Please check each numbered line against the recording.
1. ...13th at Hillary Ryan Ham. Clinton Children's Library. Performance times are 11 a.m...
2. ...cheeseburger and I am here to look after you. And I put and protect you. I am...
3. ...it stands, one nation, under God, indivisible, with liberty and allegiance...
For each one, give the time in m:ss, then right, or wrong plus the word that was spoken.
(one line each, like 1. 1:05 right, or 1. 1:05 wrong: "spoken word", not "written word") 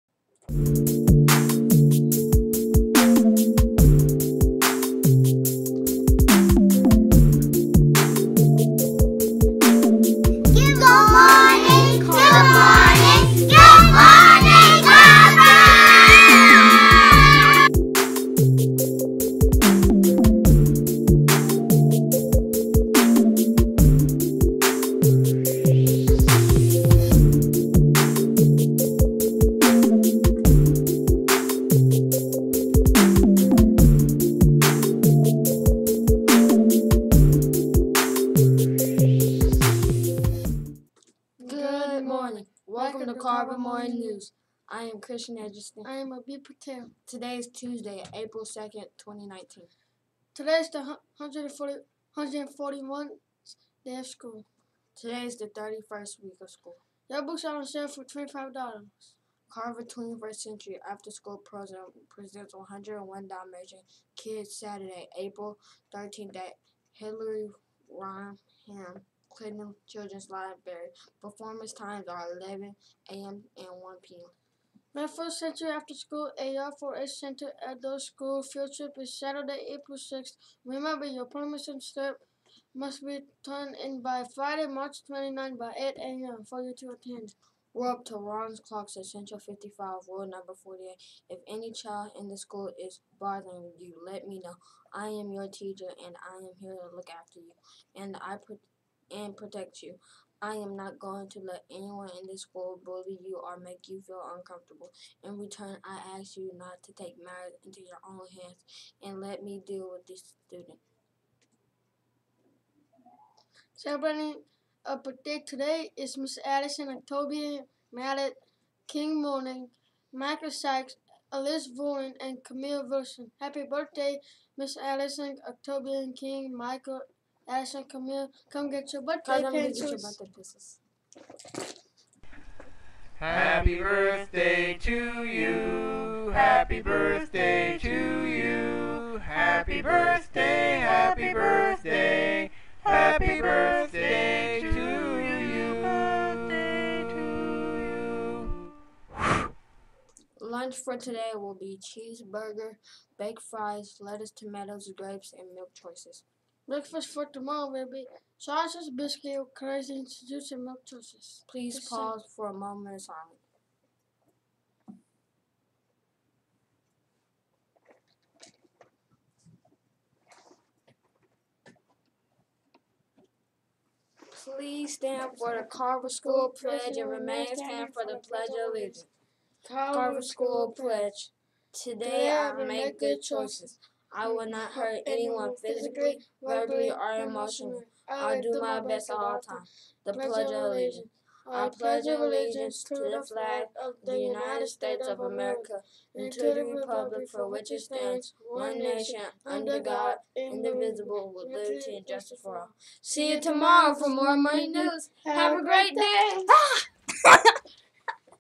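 1. 1:05 right
2. 1:35 wrong: "teacher", not "cheeseburger"
3. 3:17 wrong: "justice", not "allegiance".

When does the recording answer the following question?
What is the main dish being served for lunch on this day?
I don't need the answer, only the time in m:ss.
2:31.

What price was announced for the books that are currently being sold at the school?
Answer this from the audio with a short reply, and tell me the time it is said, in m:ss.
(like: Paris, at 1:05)
$25, at 0:58.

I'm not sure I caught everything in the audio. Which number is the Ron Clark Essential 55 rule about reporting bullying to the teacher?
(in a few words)
48.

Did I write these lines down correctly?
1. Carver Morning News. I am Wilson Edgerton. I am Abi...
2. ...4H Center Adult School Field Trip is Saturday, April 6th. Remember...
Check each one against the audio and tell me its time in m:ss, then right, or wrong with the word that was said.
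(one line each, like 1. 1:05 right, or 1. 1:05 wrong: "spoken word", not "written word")
1. 0:43 wrong: "Christian", not "Wilson"
2. 1:16 right.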